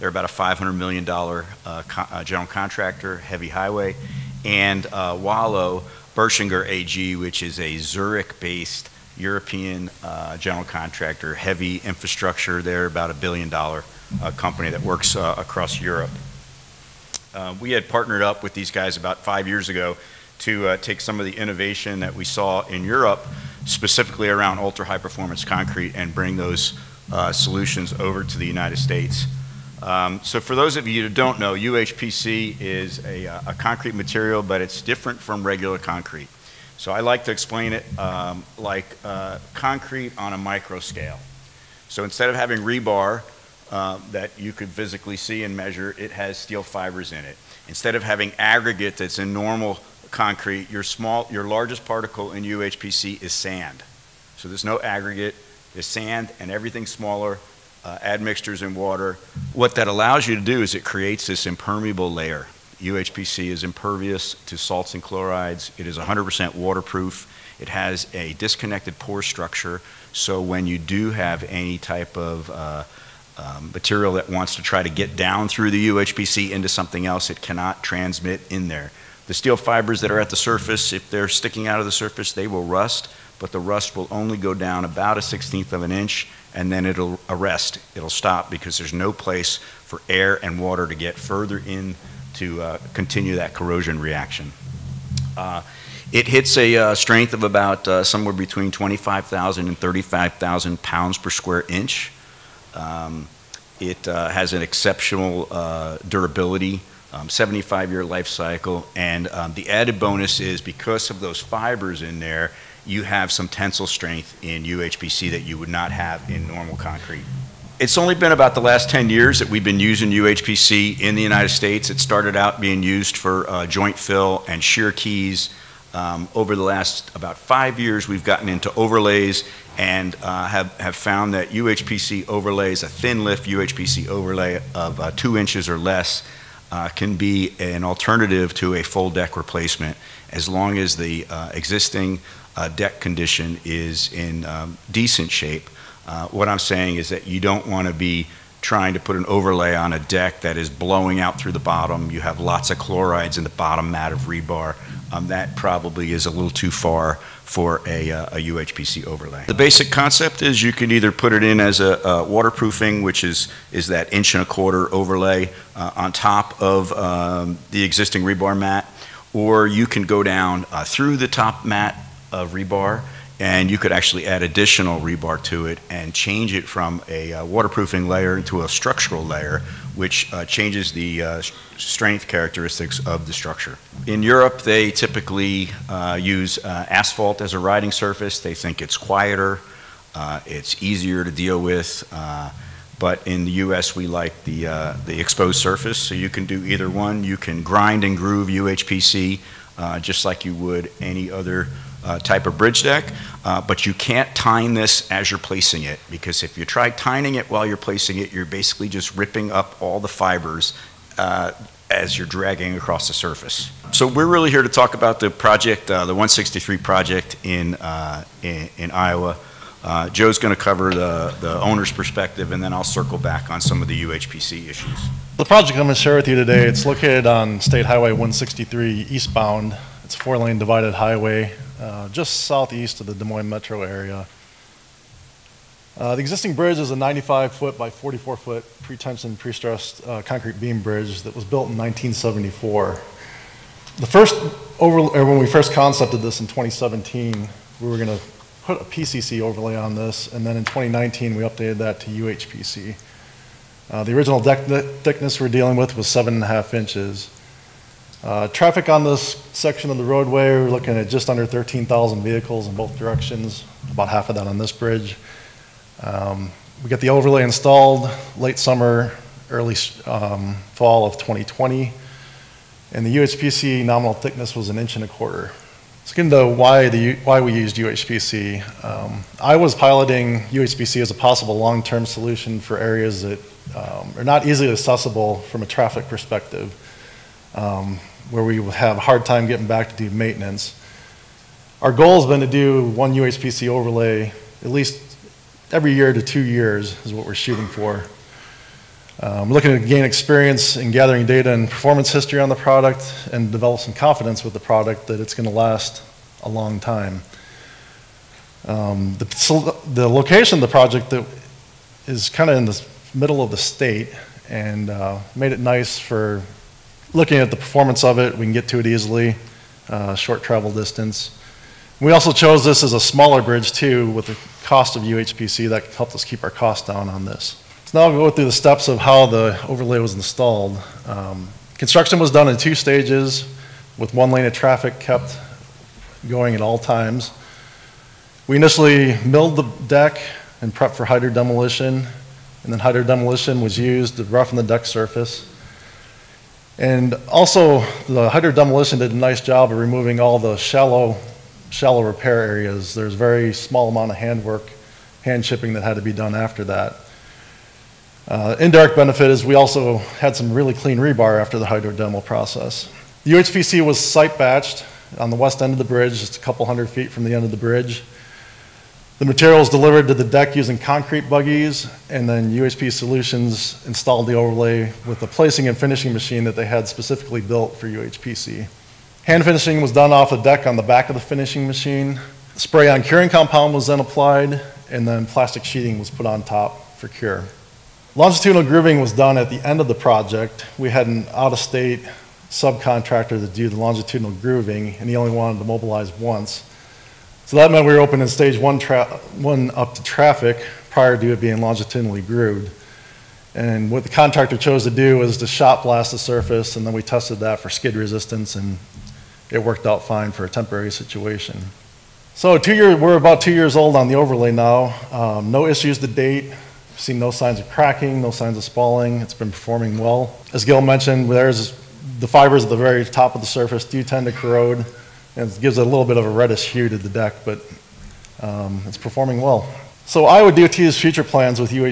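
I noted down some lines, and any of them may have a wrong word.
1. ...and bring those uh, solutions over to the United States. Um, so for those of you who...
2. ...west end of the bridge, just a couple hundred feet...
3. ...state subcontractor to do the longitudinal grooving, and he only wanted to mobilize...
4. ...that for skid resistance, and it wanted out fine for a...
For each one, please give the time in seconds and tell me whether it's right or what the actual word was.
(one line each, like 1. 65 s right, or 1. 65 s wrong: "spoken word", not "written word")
1. 25 s right
2. 365 s right
3. 391 s right
4. 407 s wrong: "worked", not "wanted".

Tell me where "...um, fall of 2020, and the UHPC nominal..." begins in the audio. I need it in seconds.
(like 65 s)
270 s.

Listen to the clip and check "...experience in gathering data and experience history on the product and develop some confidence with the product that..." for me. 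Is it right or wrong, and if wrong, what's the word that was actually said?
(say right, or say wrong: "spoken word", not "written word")
wrong: "performance", not "experience".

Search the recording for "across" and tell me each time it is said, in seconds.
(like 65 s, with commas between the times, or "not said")
15 s, 212 s.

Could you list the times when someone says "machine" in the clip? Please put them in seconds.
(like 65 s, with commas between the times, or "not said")
376 s, 381 s.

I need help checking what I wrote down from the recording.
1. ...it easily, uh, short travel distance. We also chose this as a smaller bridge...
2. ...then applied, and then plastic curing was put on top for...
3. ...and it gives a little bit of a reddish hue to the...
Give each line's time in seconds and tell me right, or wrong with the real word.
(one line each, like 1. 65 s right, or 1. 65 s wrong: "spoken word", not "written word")
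1. 318 s right
2. 383 s wrong: "sheeting", not "curing"
3. 425 s right.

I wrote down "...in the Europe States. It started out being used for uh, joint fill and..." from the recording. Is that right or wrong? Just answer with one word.
wrong.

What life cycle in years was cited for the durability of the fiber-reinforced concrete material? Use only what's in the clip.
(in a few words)
75 years.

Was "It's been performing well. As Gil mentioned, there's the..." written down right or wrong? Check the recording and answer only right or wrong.
right.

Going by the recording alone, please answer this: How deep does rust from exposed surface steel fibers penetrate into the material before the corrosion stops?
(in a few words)
A 16th of an inch.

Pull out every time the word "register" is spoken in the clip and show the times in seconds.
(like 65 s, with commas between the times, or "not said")
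not said.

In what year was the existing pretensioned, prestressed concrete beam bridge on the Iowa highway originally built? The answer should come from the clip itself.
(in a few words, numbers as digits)
1974.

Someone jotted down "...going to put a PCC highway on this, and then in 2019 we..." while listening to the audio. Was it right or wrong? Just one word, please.
wrong.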